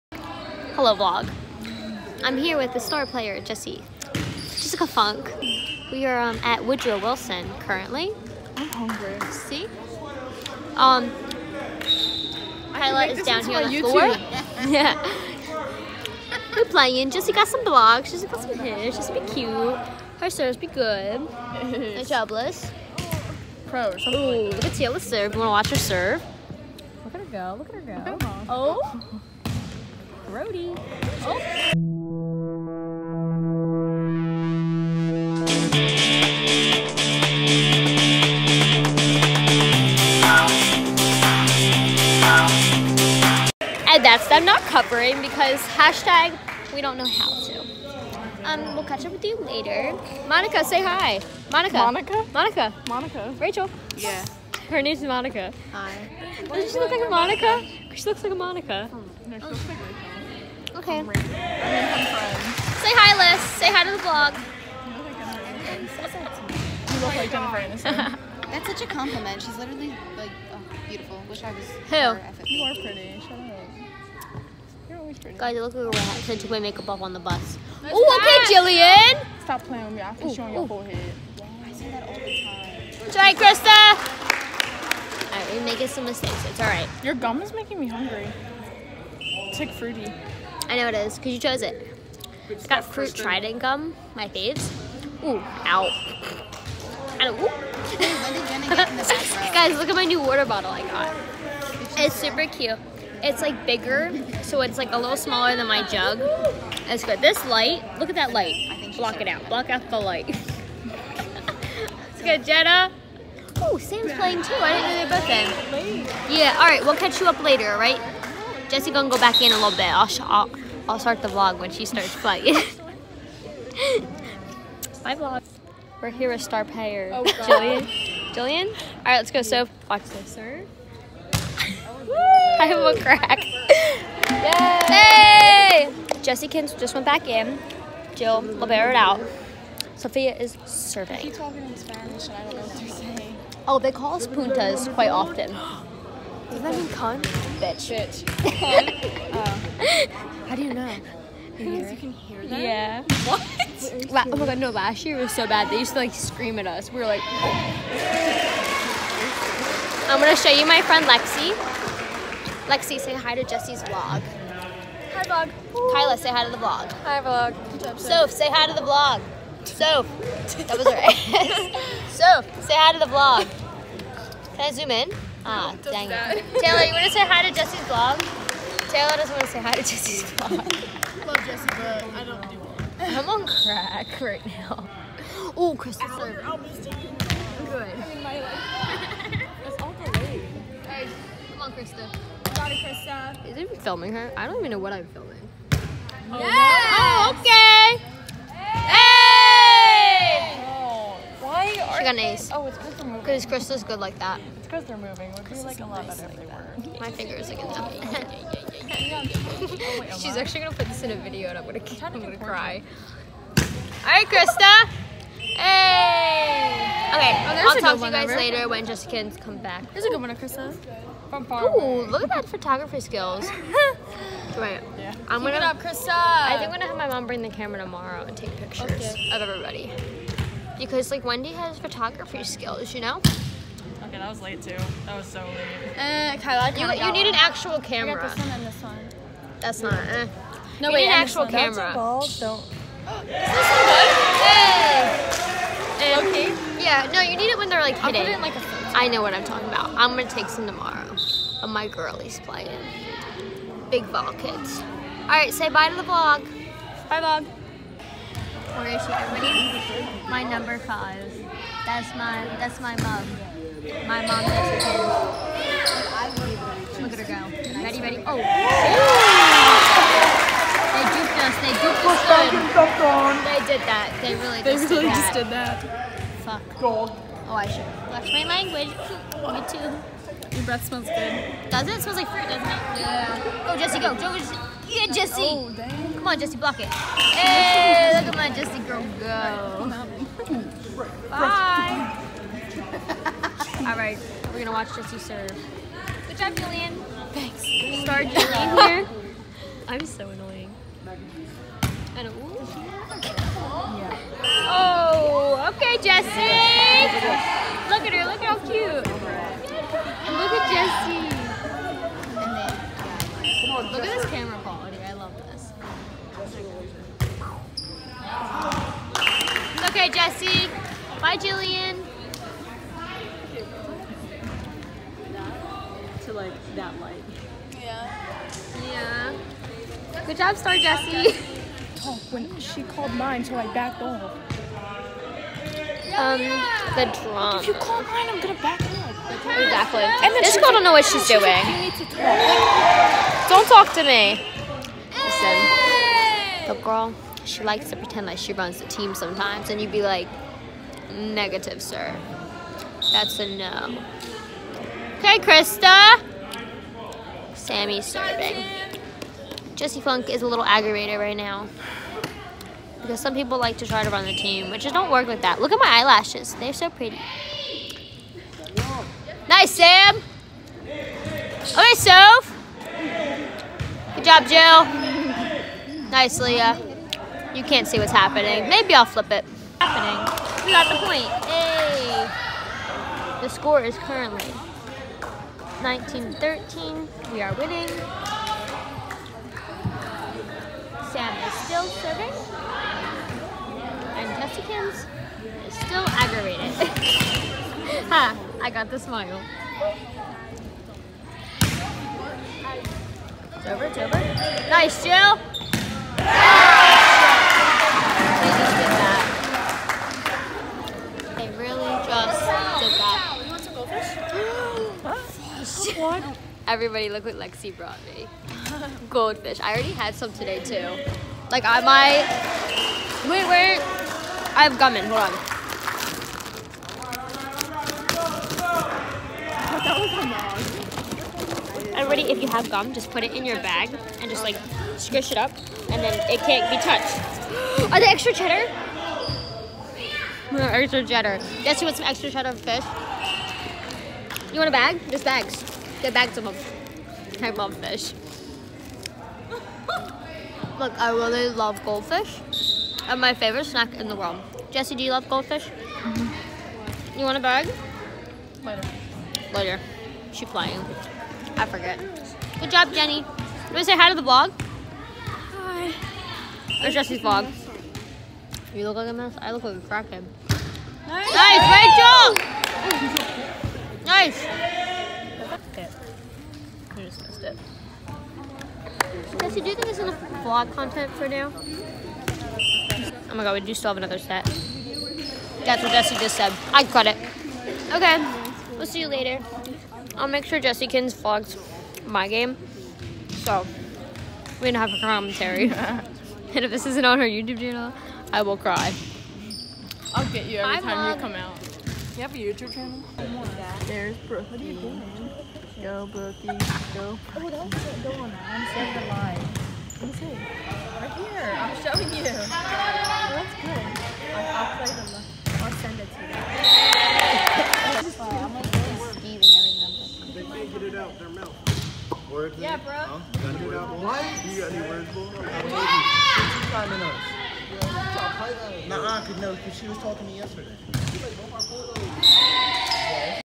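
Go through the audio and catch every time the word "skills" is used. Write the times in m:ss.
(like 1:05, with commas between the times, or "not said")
3:42, 3:52.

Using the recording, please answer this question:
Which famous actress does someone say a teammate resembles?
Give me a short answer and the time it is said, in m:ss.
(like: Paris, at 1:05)
Jennifer Aniston, at 1:07.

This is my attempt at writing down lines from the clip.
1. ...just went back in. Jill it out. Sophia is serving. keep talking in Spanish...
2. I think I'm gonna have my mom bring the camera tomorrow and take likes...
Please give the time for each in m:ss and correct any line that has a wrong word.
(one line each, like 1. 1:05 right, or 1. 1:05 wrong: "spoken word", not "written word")
1. 2:16 right
2. 3:46 wrong: "pictures", not "likes".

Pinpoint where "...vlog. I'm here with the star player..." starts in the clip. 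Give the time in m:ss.
0:00.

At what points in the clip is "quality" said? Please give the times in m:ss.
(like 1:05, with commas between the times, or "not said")
5:14.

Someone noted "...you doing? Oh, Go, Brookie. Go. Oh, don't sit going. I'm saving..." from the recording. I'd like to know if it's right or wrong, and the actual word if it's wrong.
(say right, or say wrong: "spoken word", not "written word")
right.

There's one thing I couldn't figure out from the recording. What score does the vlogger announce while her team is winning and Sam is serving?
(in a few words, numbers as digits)
19-13.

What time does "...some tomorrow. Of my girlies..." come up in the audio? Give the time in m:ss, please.
4:10.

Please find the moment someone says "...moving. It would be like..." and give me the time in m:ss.
3:24.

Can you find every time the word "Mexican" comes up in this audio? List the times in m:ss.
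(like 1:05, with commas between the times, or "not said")
4:24.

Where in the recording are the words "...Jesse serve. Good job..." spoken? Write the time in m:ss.
4:54.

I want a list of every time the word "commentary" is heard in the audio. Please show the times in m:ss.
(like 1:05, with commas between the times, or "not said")
8:14.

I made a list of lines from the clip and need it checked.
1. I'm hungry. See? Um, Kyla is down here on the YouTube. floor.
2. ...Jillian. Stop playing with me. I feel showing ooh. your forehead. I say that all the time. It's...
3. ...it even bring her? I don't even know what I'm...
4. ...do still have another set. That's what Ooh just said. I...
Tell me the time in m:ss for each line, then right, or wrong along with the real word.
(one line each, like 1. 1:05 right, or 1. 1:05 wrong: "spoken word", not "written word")
1. 0:08 right
2. 1:18 right
3. 3:13 wrong: "filming", not "bring"
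4. 8:03 wrong: "Jesse", not "Ooh".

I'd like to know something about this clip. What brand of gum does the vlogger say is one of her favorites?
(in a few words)
Trident.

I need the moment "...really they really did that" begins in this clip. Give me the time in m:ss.
4:34.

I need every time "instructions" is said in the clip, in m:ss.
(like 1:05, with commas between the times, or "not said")
not said.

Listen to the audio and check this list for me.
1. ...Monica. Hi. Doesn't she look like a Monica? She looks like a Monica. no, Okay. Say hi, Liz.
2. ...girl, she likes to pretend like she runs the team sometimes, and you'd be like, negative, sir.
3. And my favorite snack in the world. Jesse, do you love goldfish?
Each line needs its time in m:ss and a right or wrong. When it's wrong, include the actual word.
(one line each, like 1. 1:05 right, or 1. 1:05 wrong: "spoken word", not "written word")
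1. 0:55 right
2. 5:46 right
3. 7:33 right.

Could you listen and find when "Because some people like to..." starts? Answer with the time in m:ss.
6:03.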